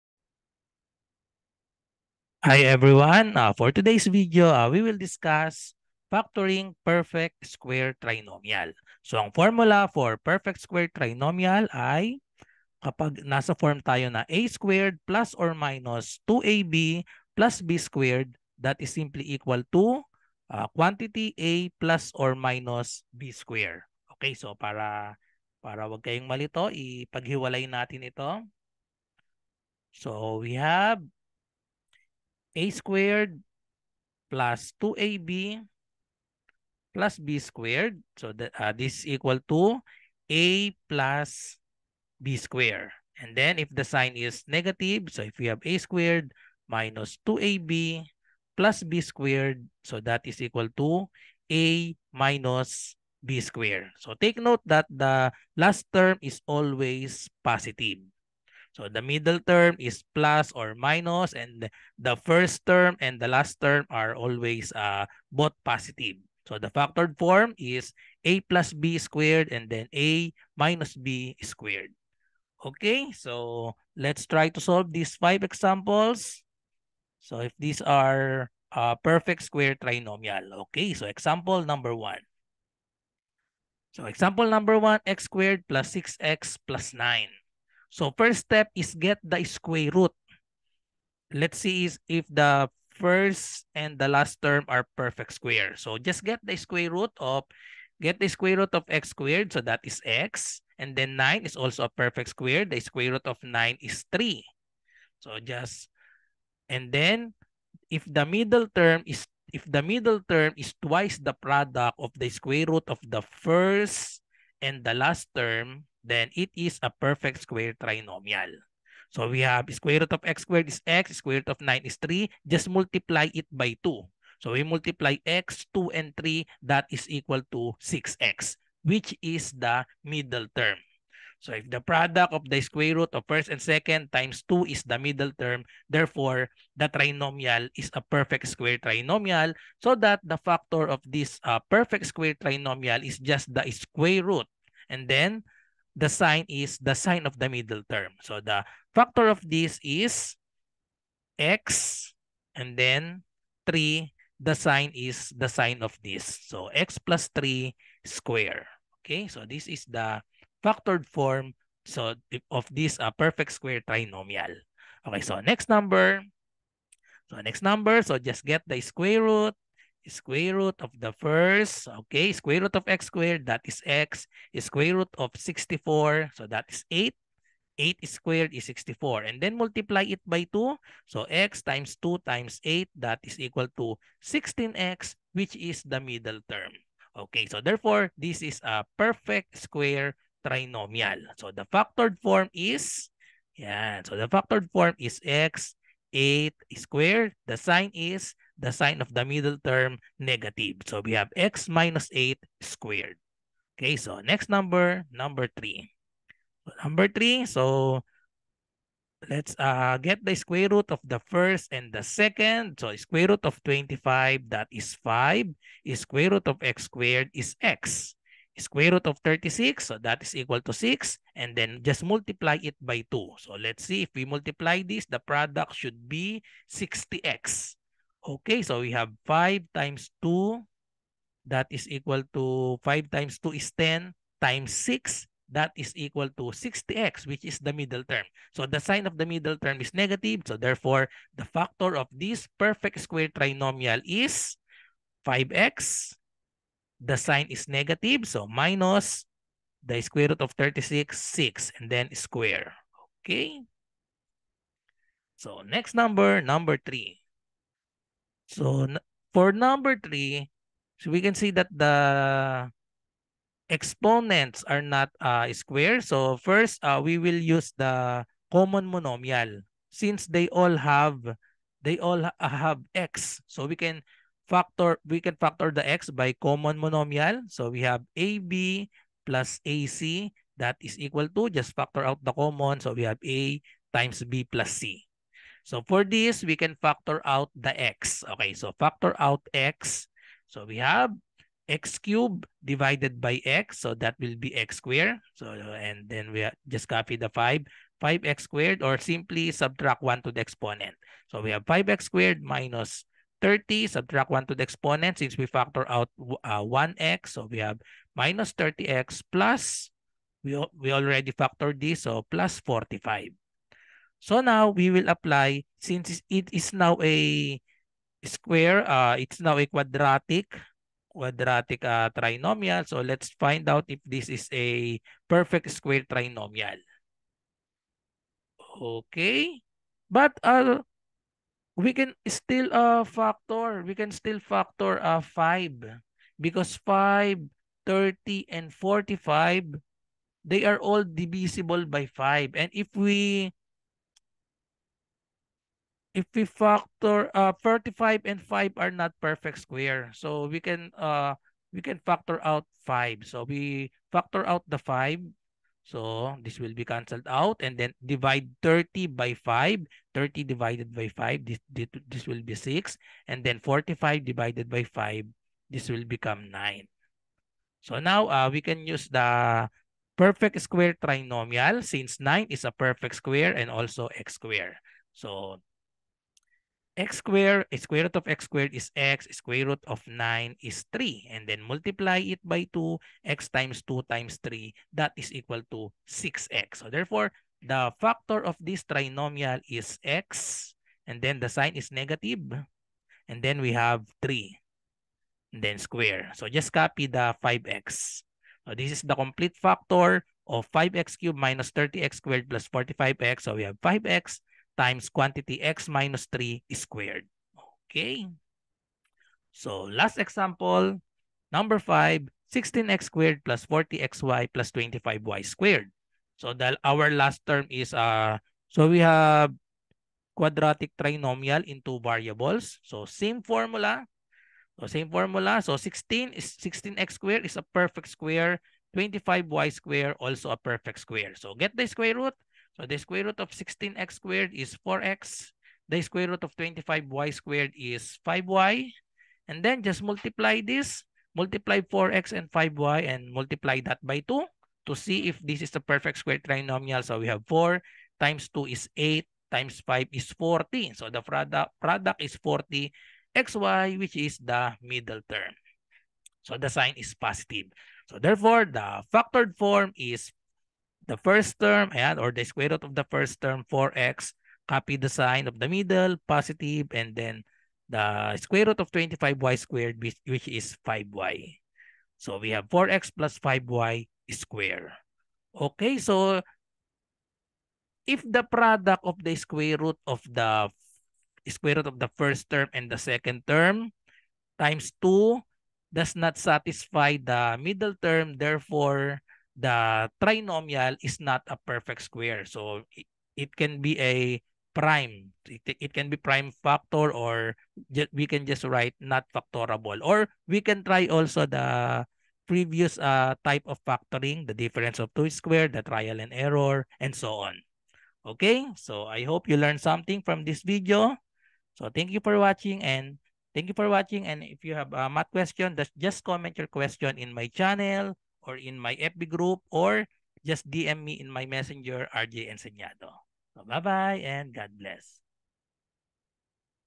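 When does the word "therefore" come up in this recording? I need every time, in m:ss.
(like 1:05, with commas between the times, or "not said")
2:15, 3:07, 4:00, 6:26, 7:38, 8:08.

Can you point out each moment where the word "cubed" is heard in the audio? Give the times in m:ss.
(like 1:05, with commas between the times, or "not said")
4:52, 6:41.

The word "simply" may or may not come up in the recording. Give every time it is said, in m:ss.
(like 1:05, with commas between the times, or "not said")
0:18, 4:58.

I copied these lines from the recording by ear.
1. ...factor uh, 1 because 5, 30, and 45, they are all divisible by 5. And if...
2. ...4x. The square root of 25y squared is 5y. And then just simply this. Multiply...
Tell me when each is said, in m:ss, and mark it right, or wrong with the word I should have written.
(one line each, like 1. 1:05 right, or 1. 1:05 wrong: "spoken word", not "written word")
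1. 5:34 wrong: "5", not "1"
2. 7:14 wrong: "multiply", not "simply".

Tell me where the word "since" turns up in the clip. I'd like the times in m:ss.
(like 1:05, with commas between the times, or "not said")
4:29, 5:05, 5:15, 6:11.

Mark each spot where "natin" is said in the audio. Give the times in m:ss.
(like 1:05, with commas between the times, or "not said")
0:27.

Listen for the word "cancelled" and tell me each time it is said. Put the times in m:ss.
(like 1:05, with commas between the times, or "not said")
5:56.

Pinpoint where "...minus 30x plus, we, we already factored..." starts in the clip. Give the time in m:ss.
5:08.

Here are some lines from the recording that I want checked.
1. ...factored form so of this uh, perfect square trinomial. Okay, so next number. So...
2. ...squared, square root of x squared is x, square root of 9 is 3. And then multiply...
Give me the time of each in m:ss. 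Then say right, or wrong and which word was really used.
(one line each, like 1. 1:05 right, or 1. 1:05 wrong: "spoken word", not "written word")
1. 2:40 right
2. 6:17 right.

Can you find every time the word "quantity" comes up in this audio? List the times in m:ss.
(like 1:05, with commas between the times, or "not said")
0:20, 6:45.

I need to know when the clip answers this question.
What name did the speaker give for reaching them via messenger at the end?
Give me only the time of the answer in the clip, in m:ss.
8:42.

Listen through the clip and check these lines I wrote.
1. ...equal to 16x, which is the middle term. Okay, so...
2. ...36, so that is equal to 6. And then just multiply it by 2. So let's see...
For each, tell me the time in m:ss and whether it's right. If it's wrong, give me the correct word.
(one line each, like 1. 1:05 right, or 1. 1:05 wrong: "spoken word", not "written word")
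1. 3:03 right
2. 3:39 right.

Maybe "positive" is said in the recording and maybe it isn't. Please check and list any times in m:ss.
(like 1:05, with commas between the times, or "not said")
0:57, 1:05, 7:37, 7:46.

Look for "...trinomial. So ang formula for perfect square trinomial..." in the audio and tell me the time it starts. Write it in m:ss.
0:08.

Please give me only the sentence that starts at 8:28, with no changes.
Okay, so I hope you learned something from this video.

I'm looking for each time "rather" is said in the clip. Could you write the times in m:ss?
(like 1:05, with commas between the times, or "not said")
not said.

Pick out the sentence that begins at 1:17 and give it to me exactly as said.
So if these are uh, perfect square trinomial.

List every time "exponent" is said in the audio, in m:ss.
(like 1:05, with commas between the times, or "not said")
4:23, 5:00, 5:04.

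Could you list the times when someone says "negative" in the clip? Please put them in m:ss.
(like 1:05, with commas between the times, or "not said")
0:44, 3:20, 3:59, 4:07, 6:31.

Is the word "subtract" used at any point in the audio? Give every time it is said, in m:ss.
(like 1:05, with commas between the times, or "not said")
4:59, 5:03.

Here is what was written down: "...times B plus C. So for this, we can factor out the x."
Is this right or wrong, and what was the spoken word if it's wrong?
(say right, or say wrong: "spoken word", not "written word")
right.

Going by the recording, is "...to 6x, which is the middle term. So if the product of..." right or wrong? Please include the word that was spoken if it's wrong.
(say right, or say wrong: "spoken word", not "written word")
right.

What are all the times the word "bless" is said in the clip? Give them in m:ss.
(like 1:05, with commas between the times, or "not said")
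8:44.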